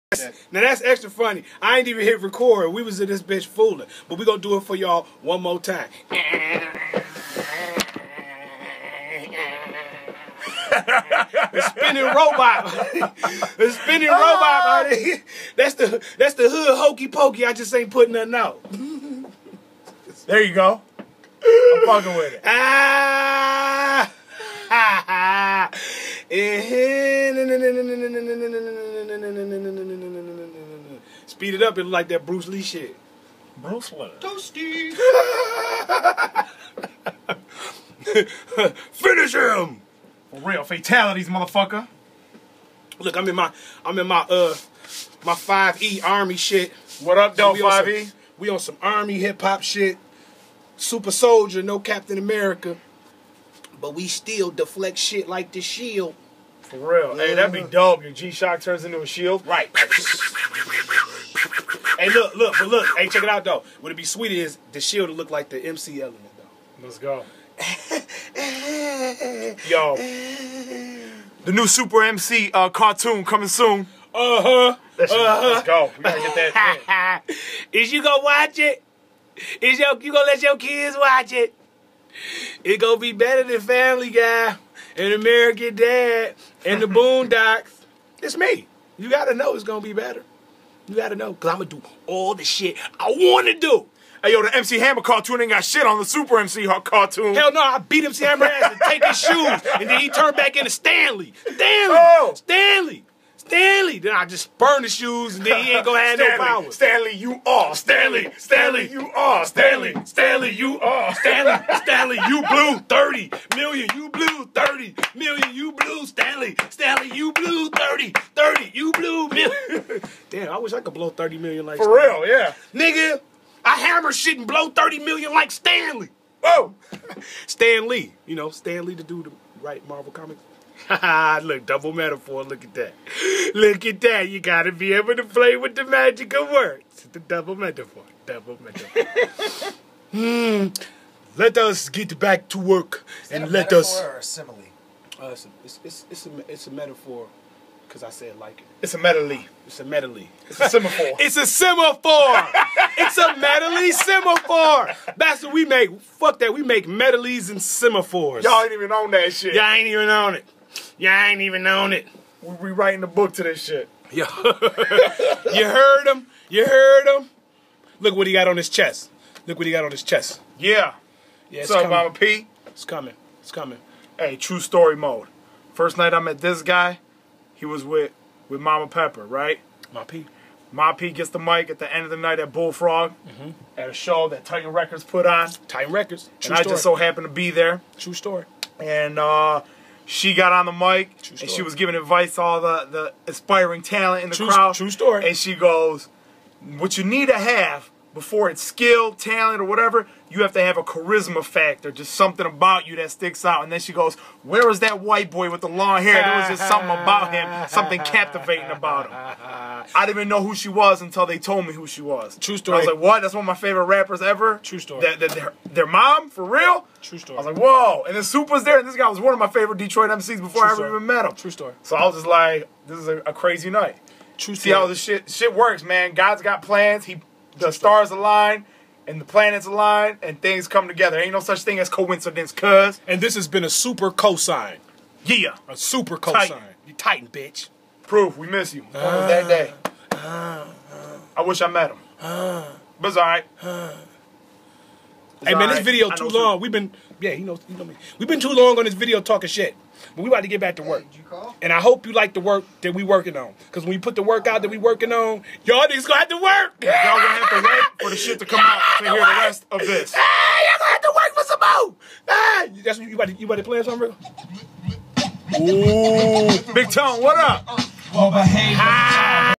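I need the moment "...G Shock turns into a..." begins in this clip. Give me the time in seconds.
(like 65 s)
58 s.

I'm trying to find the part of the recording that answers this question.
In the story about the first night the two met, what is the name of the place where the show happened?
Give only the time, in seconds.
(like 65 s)
182 s.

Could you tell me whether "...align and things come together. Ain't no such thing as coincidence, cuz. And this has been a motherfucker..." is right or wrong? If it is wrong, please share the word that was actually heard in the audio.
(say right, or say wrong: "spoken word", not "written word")
wrong: "super", not "motherfucker".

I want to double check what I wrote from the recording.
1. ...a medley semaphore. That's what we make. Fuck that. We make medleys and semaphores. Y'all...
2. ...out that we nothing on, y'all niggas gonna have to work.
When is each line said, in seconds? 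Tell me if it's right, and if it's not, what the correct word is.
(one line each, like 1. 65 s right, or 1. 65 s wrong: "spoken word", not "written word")
1. 153 s right
2. 254 s wrong: "working", not "nothing".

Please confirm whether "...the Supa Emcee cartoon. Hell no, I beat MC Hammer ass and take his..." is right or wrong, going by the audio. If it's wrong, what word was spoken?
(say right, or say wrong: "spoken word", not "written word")
right.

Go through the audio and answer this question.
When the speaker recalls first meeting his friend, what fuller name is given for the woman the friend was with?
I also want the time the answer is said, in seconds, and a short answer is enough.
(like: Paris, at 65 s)
Mama Pepper, at 178 s.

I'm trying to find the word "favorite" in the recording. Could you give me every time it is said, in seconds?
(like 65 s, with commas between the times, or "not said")
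213 s, 219 s.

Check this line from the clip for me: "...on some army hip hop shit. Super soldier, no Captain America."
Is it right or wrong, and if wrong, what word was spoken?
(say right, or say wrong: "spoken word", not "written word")
right.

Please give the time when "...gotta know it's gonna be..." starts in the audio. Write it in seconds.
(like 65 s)
89 s.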